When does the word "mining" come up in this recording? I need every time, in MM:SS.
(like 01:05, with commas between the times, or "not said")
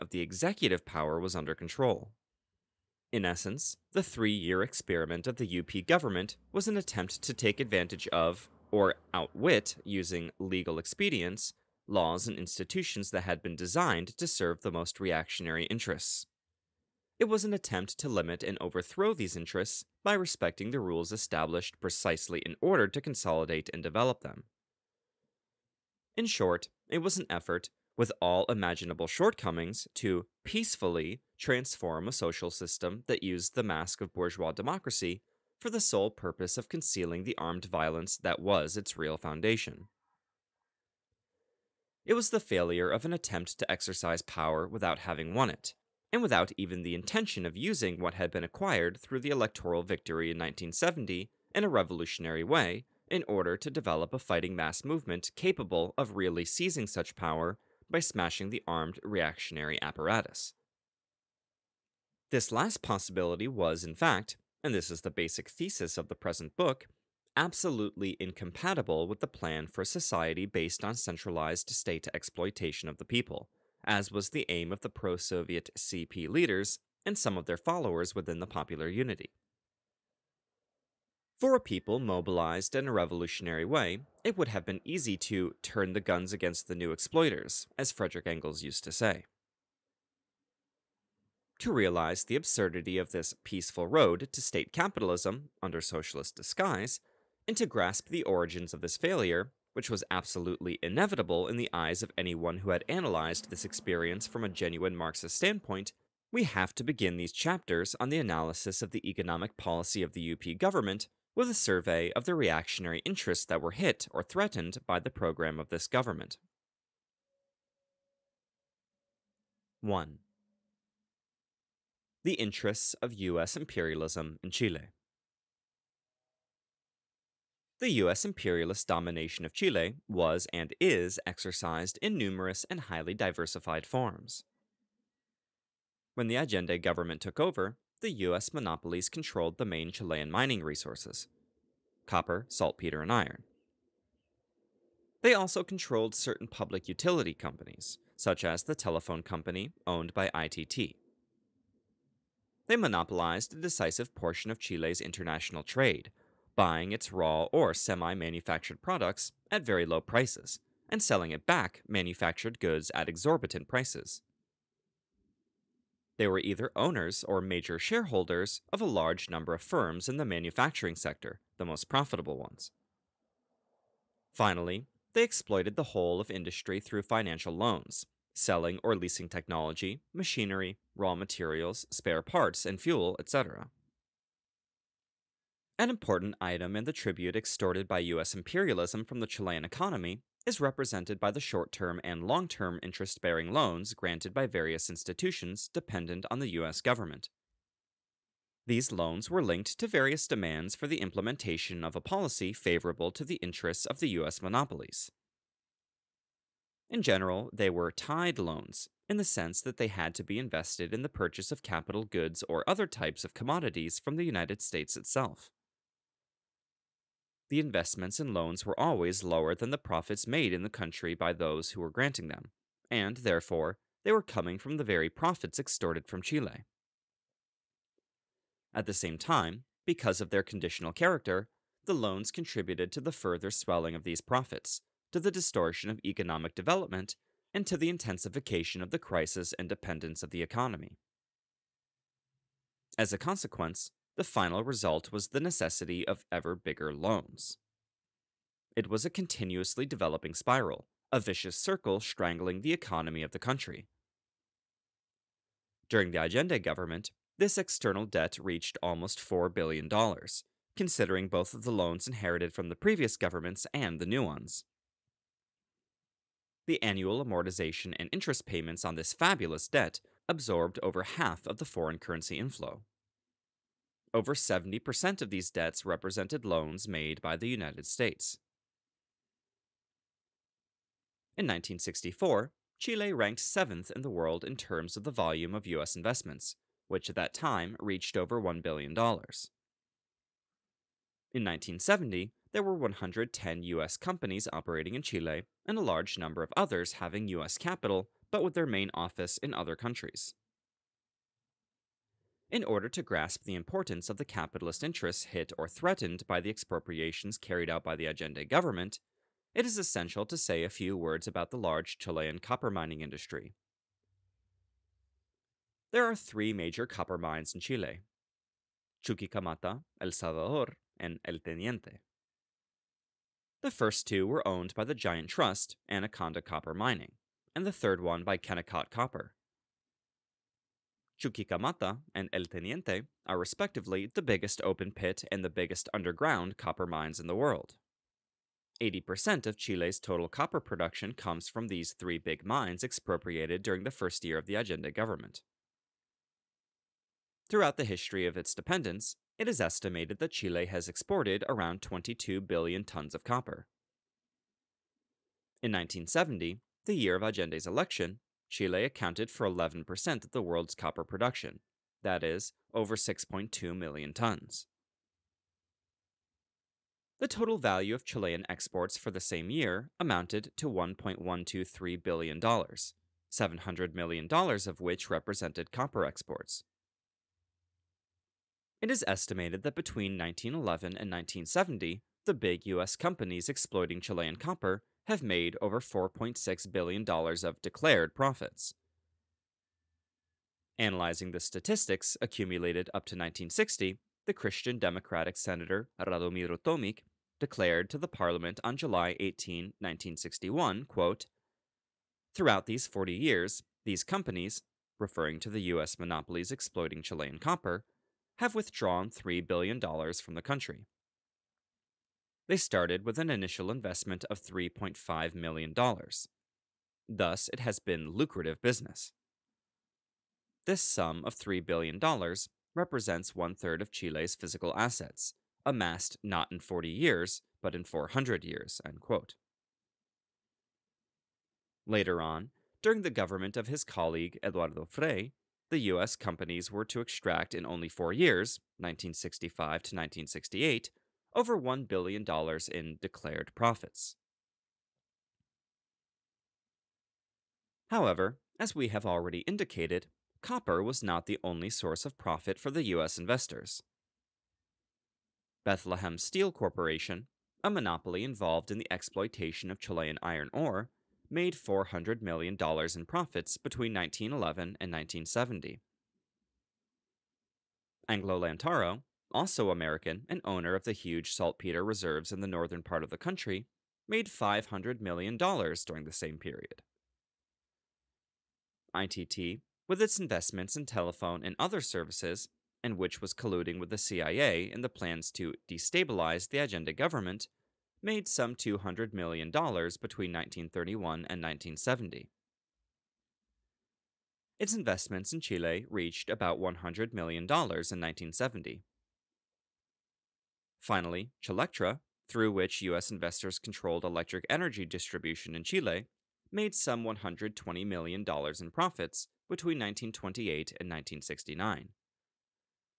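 02:20, 05:12, 05:26.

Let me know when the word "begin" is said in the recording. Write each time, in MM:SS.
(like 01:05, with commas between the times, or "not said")
01:46.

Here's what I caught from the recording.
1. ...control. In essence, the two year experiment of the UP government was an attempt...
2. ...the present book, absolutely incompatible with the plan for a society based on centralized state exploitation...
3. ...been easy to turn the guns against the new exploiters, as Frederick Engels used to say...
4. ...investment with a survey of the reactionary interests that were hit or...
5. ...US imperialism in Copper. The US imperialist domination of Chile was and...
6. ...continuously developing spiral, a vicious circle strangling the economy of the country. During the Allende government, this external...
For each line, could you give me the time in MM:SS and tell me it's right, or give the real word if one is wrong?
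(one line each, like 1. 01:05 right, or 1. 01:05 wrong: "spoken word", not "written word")
1. 00:01 wrong: "three", not "two"
2. 01:06 right
3. 01:24 right
4. 01:50 wrong: "government", not "investment"
5. 02:03 wrong: "Chile", not "Copper"
6. 04:09 right.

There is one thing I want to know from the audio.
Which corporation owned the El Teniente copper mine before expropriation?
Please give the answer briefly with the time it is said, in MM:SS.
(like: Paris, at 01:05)
Kennecott Copper, at 05:28.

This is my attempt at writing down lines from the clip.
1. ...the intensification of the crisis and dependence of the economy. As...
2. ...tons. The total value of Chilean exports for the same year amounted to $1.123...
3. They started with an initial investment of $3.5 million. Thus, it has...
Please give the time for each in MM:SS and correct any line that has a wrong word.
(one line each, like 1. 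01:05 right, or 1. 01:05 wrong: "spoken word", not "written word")
1. 03:57 right
2. 06:04 right
3. 06:52 right.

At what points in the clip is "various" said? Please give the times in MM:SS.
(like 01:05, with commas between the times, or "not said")
03:14, 03:19.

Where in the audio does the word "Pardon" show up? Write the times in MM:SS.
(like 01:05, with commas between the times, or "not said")
not said.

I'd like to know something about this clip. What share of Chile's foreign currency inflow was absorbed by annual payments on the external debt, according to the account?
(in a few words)
over half.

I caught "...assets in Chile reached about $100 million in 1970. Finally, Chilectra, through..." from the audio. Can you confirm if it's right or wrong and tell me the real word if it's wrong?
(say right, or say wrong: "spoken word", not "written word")
wrong: "investments", not "assets".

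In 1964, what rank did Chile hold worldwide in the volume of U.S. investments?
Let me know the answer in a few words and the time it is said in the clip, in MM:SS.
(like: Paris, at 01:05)
seventh, at 04:43.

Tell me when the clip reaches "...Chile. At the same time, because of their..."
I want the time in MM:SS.
03:46.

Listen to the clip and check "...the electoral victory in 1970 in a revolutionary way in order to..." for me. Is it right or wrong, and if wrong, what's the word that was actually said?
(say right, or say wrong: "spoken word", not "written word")
right.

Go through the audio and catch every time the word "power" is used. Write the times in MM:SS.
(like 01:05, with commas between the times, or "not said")
00:00, 00:44, 00:57.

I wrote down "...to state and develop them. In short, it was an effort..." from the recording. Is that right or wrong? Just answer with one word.
wrong.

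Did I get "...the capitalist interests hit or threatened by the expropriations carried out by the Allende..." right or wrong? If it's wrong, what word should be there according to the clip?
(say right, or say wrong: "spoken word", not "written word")
right.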